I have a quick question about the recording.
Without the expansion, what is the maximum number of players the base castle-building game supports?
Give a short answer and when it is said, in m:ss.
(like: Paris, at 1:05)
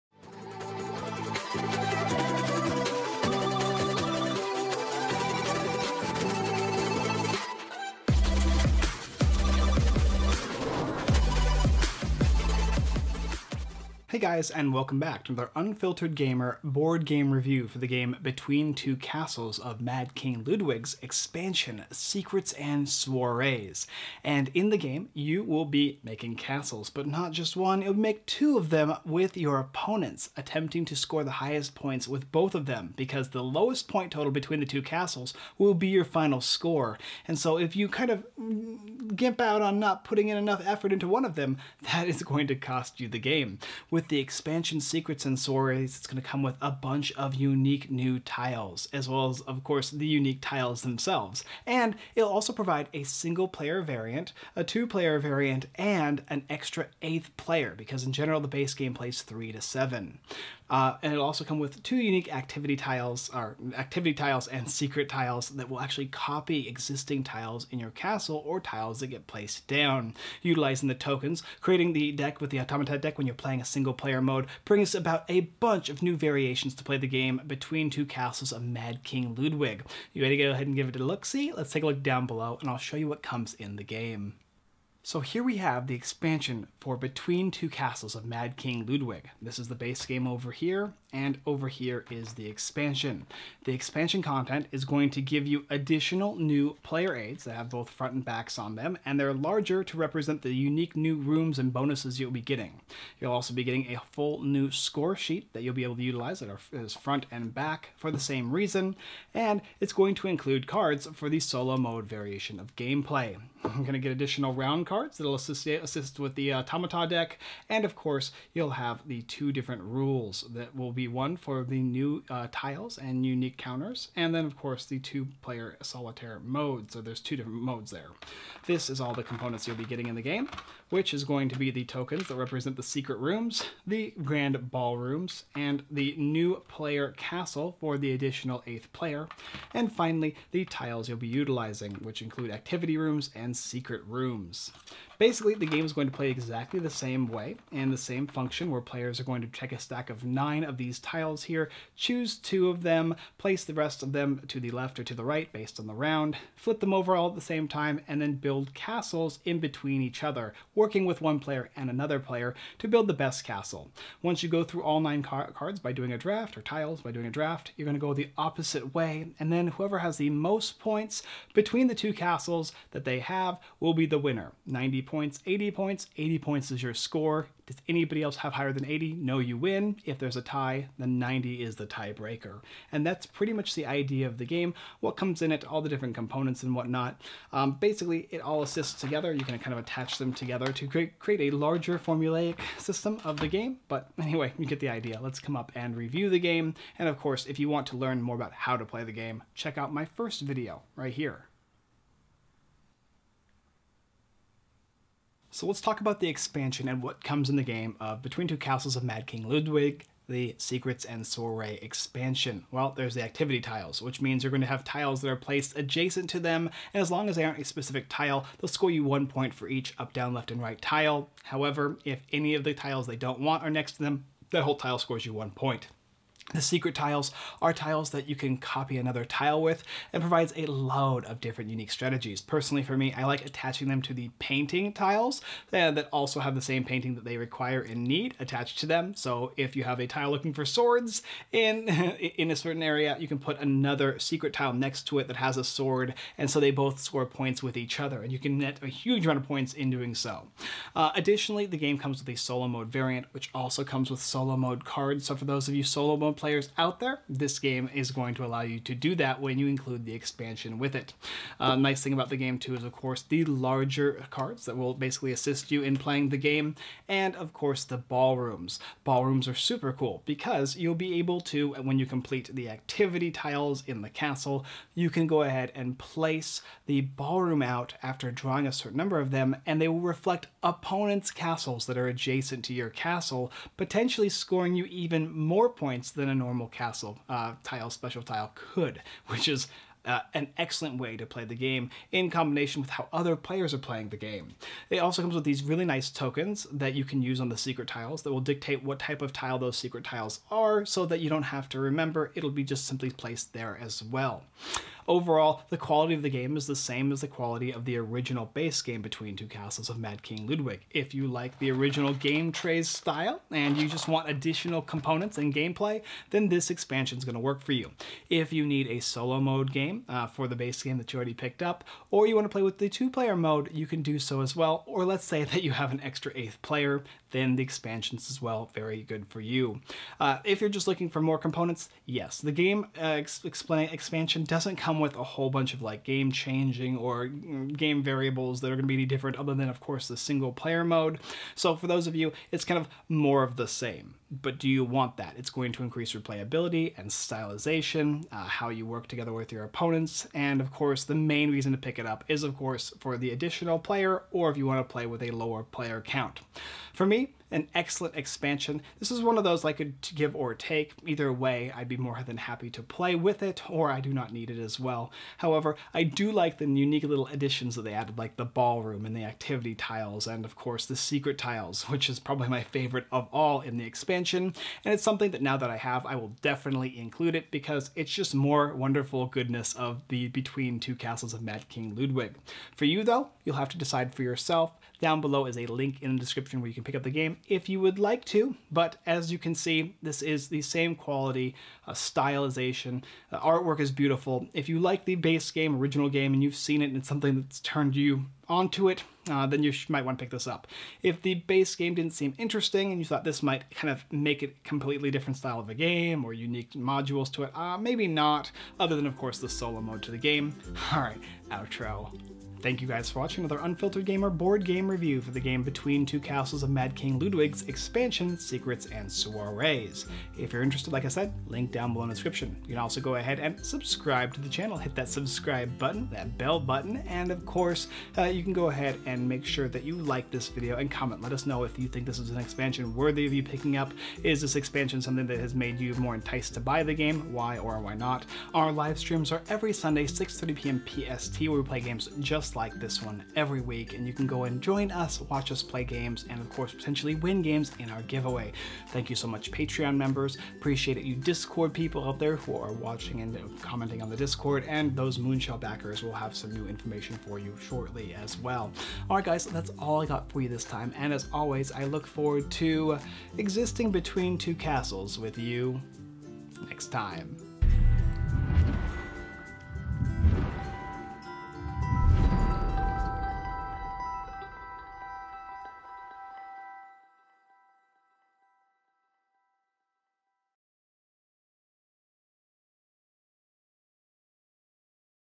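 7, at 0:59.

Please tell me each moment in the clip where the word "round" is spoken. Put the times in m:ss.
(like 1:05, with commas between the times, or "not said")
1:54, 2:35.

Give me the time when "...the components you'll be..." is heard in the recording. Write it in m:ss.
2:09.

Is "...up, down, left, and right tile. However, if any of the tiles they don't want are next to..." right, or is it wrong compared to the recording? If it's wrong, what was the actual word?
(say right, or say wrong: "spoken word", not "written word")
right.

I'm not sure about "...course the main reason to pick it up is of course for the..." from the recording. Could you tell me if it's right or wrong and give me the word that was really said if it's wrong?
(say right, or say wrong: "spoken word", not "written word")
right.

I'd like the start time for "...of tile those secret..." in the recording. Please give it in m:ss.
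4:59.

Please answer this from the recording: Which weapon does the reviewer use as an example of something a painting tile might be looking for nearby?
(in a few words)
swords.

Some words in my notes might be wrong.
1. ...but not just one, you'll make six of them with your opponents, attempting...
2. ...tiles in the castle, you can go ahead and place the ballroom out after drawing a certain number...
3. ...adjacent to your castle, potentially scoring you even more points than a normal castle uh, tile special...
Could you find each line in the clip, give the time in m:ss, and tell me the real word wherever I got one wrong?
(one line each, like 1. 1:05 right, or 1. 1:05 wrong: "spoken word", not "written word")
1. 0:26 wrong: "two", not "six"
2. 4:33 right
3. 4:42 right.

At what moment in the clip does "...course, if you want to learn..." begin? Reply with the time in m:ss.
3:17.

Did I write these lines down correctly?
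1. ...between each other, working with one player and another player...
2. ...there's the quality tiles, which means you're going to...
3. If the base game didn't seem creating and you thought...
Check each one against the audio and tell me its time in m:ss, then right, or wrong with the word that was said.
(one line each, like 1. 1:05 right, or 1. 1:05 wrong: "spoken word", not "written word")
1. 2:39 right
2. 3:32 wrong: "activity", not "quality"
3. 6:41 wrong: "interesting", not "creating".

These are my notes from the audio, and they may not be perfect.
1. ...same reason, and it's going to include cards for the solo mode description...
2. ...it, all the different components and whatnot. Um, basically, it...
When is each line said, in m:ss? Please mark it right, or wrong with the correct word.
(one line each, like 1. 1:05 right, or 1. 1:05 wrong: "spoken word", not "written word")
1. 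1:48 wrong: "variation", not "description"
2. 3:05 right.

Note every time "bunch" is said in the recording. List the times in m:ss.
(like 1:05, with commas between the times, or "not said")
0:46, 1:15, 5:35.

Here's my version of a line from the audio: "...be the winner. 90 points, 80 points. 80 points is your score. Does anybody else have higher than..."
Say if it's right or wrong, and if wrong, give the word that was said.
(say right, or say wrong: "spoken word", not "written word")
right.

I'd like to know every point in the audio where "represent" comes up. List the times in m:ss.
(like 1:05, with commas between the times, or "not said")
1:39, 2:12.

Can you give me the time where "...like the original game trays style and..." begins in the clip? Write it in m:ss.
5:11.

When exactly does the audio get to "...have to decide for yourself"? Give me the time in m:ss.
6:23.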